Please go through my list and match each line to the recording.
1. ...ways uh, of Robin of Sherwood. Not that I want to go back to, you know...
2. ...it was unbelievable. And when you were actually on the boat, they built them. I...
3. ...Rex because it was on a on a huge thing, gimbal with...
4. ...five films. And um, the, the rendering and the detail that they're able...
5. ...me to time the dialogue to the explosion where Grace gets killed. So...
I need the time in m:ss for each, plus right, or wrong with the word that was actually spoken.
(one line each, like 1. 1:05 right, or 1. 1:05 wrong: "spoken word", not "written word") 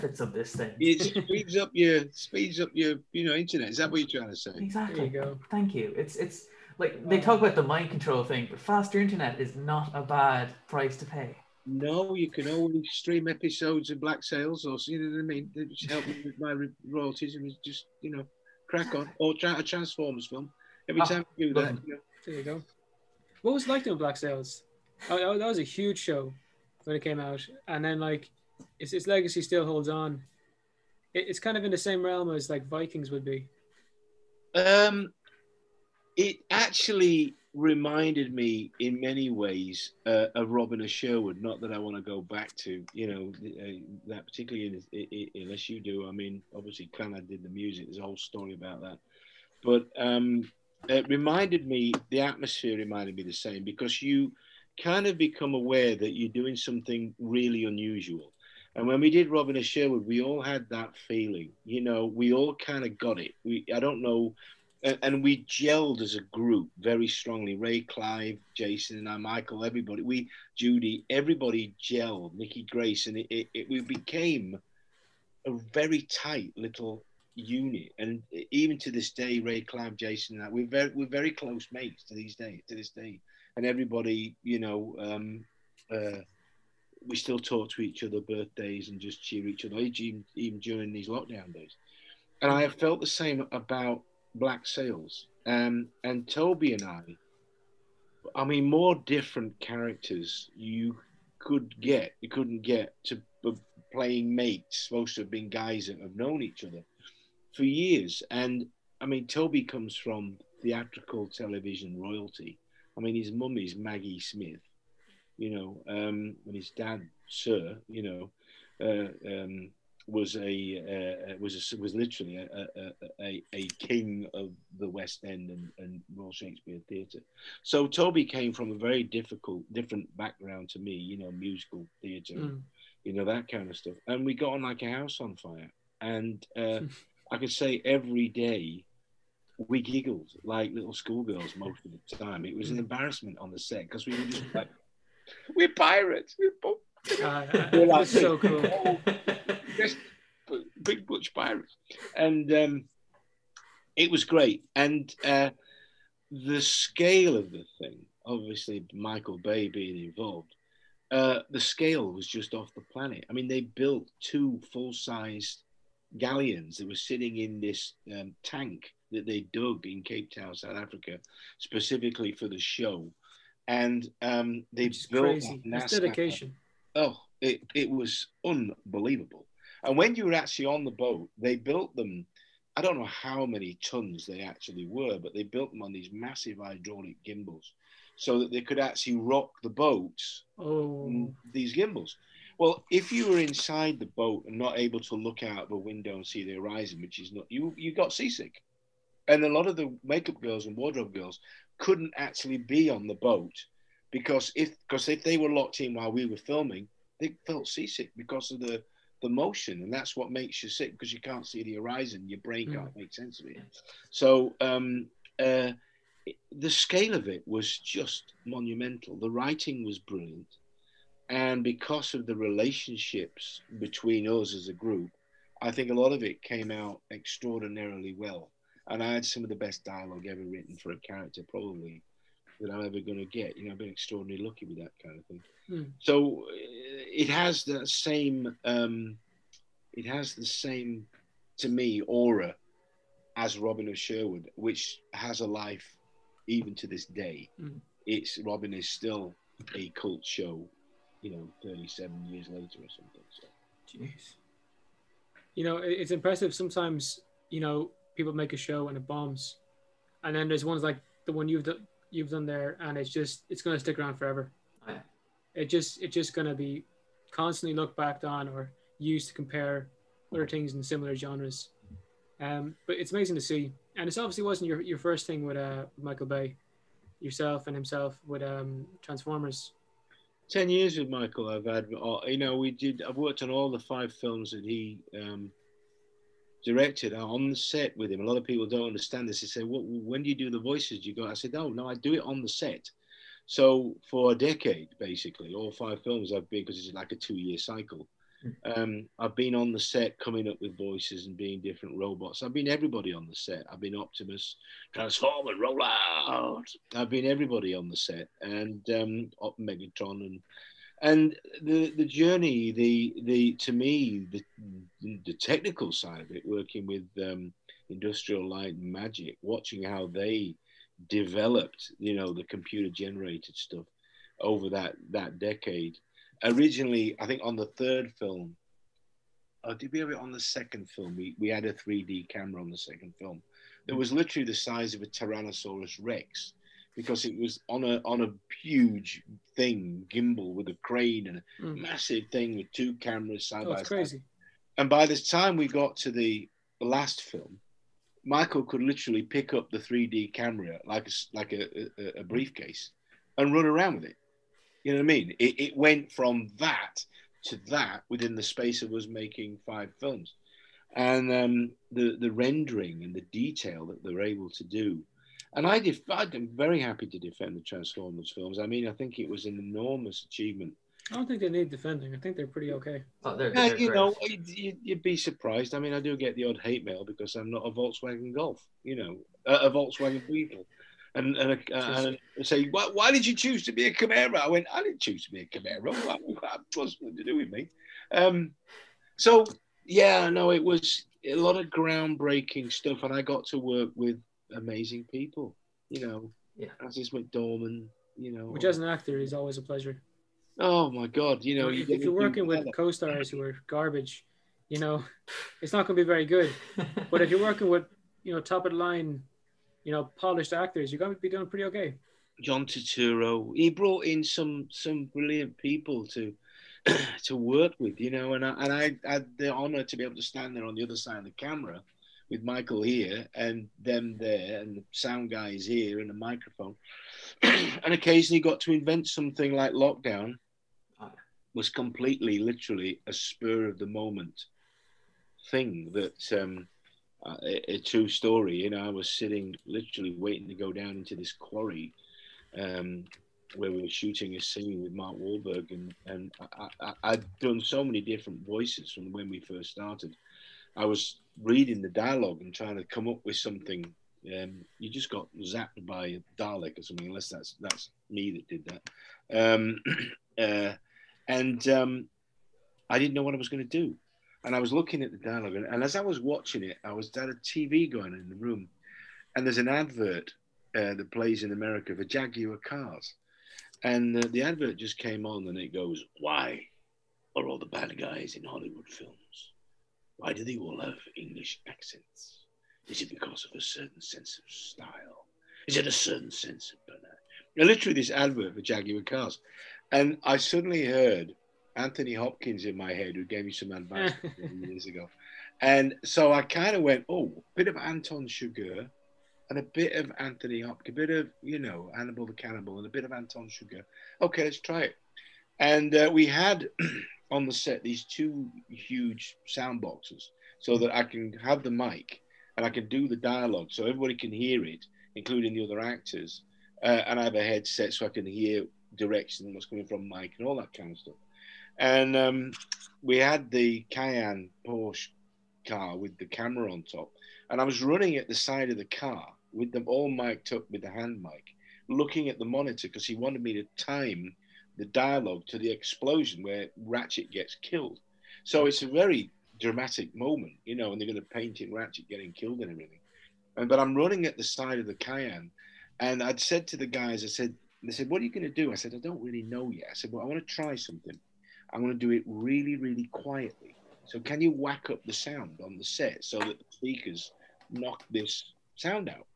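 1. 0:39 right
2. 2:57 right
3. 5:36 right
4. 5:59 right
5. 8:53 wrong: "Ratchet", not "Grace".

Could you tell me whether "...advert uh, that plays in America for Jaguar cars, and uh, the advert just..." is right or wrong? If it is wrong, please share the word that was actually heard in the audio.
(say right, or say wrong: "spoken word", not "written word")
right.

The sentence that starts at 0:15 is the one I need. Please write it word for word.
It just help me with my royalties and just you know crack on or try a Transformers film.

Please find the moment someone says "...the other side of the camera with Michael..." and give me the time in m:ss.
7:00.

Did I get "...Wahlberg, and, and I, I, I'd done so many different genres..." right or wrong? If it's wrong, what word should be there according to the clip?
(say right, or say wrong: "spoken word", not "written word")
wrong: "voices", not "genres".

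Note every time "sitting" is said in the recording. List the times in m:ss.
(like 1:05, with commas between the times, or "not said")
2:46, 7:19.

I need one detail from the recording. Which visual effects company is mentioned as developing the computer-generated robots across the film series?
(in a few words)
Industrial Light and Magic.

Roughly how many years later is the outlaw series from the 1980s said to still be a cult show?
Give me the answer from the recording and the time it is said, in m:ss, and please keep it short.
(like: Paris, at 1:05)
37, at 4:11.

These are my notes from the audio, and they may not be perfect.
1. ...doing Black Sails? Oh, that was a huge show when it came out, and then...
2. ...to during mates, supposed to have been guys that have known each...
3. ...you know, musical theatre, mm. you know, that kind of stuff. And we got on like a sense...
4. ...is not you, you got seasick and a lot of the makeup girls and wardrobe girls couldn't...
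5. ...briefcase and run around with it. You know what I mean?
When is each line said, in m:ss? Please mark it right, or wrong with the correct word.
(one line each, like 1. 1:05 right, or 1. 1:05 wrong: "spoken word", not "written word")
1. 0:23 right
2. 1:43 wrong: "playing", not "during"
3. 2:10 wrong: "house", not "sense"
4. 3:17 right
5. 5:52 right.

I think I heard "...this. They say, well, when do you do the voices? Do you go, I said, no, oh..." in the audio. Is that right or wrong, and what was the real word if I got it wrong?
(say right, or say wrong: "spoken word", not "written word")
right.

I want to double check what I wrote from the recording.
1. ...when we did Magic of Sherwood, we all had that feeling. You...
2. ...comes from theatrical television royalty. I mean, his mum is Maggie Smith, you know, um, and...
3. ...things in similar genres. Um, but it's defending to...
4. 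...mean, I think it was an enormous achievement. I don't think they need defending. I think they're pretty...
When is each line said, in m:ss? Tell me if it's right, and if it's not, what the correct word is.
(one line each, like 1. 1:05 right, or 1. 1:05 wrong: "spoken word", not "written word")
1. 0:58 wrong: "Robin", not "Magic"
2. 1:49 right
3. 4:30 wrong: "amazing", not "defending"
4. 6:08 right.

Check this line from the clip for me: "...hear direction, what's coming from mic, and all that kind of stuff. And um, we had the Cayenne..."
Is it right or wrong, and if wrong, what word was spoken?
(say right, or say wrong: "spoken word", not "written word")
right.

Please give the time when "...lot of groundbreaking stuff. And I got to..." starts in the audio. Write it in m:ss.
6:31.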